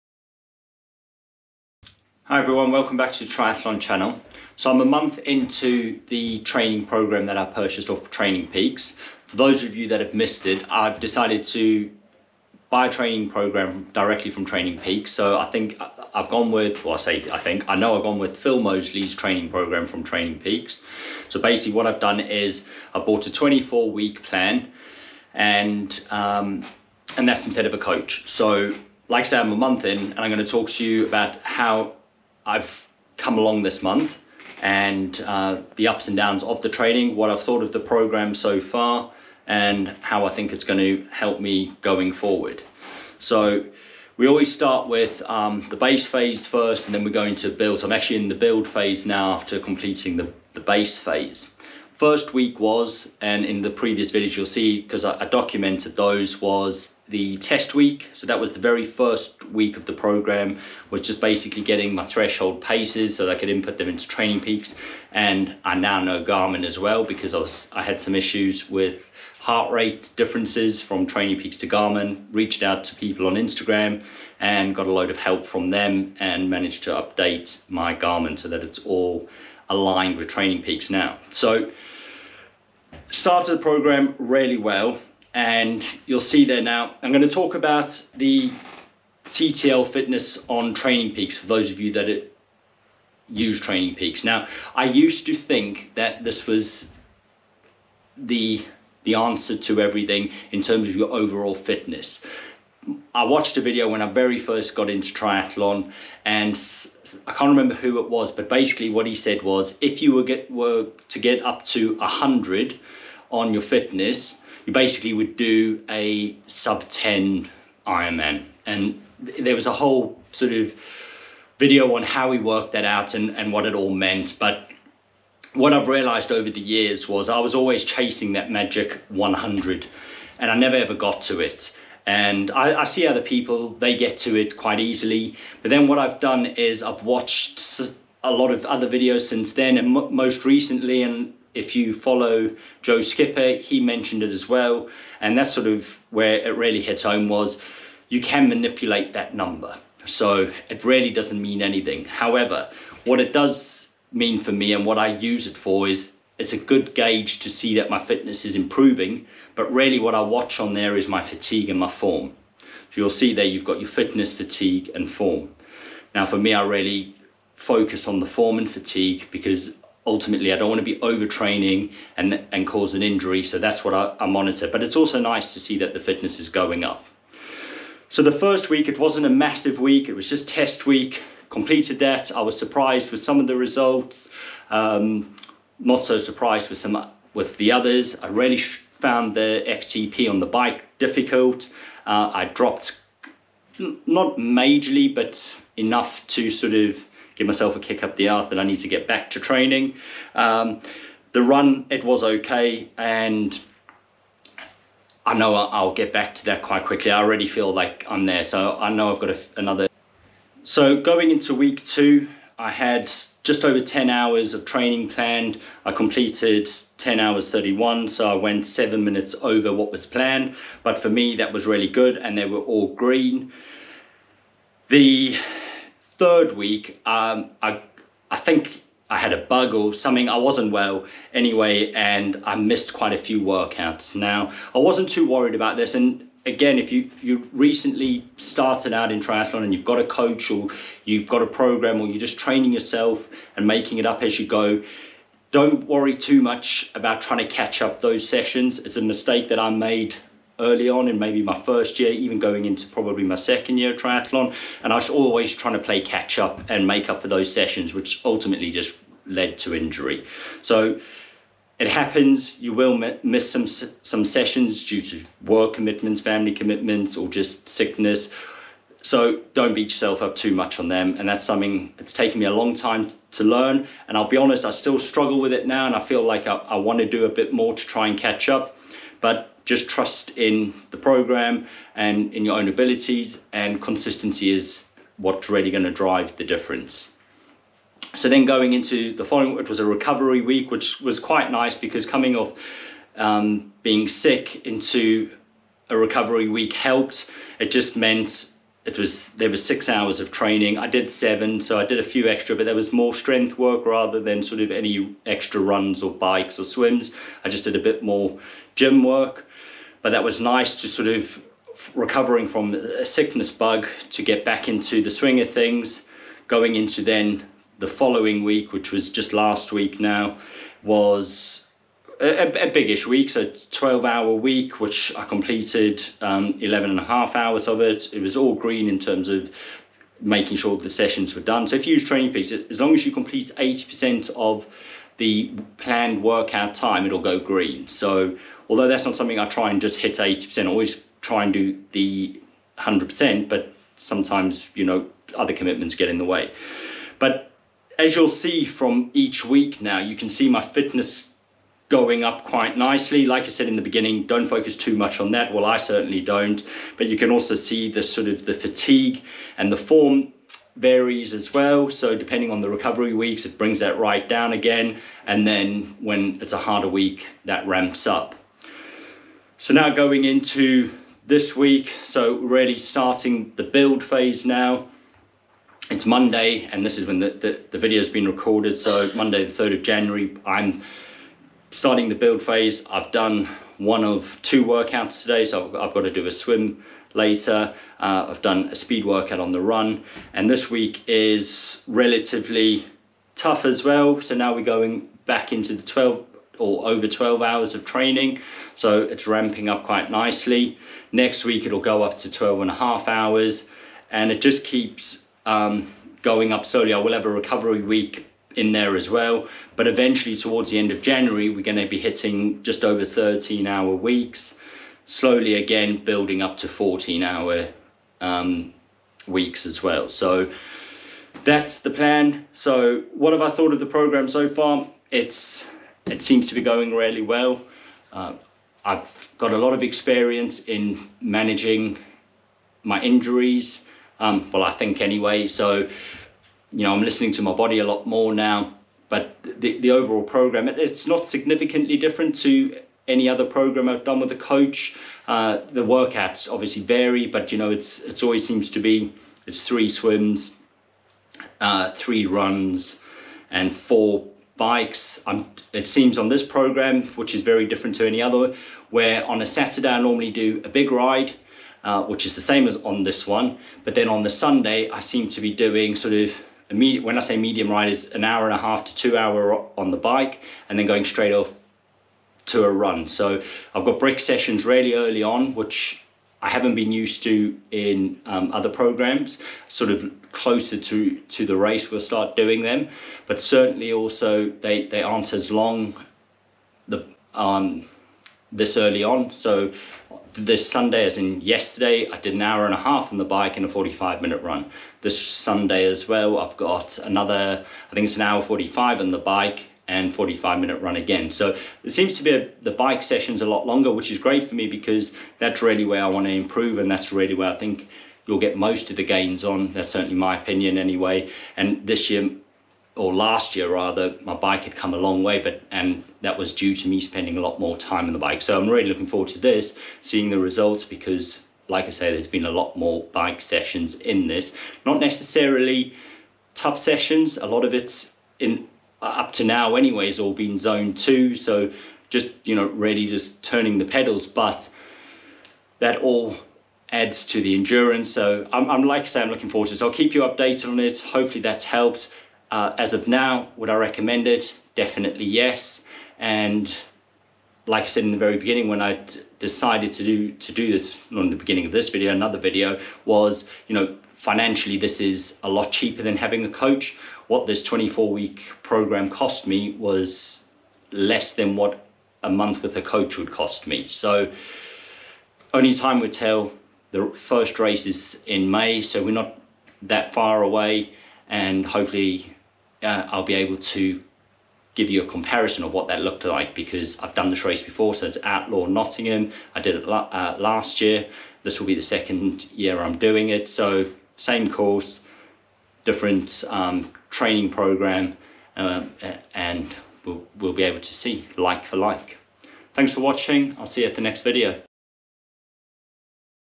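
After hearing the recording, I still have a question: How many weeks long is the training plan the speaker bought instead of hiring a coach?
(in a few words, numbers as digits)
24.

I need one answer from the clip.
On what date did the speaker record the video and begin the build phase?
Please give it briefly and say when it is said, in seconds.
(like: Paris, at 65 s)
Monday 3rd of January, at 379 s.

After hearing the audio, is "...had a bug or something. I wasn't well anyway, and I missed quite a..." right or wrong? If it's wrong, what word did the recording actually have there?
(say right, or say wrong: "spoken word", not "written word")
right.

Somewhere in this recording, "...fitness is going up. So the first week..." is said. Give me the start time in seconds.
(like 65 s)
175 s.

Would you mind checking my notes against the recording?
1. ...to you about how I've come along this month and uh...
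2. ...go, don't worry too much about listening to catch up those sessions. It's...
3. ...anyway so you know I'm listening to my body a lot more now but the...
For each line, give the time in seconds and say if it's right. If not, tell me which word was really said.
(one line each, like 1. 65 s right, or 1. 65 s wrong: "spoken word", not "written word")
1. 30 s right
2. 244 s wrong: "trying", not "listening"
3. 435 s right.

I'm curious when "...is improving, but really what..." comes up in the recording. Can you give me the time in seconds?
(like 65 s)
158 s.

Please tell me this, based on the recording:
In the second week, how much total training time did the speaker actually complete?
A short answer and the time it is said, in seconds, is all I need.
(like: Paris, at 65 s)
10 hours 31, at 216 s.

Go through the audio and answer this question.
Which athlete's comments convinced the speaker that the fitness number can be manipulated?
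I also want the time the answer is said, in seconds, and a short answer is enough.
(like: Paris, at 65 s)
Joe Skipper, at 142 s.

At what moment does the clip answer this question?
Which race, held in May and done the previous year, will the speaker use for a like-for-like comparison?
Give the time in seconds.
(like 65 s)
578 s.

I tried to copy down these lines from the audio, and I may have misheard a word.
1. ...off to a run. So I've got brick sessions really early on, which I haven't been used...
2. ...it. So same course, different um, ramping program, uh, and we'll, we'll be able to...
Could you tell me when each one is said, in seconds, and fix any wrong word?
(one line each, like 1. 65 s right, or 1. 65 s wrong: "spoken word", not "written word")
1. 471 s right
2. 583 s wrong: "training", not "ramping".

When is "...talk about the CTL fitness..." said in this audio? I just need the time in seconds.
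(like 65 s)
87 s.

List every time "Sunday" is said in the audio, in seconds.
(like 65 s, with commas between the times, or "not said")
464 s, 490 s, 495 s.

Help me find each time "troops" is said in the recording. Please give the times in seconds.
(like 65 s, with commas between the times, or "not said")
not said.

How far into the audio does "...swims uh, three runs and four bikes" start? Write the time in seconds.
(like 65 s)
449 s.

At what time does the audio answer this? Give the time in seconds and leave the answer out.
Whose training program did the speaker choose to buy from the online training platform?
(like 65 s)
18 s.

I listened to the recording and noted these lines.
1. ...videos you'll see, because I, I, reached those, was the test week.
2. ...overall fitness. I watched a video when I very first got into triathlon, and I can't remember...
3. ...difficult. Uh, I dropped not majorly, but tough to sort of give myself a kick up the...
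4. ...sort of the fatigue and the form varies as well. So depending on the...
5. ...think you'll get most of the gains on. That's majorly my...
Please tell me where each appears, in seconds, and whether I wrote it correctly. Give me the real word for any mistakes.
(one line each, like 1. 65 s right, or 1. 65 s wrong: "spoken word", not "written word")
1. 54 s wrong: "documented", not "reached"
2. 101 s right
3. 190 s wrong: "enough", not "tough"
4. 358 s right
5. 507 s wrong: "certainly", not "majorly".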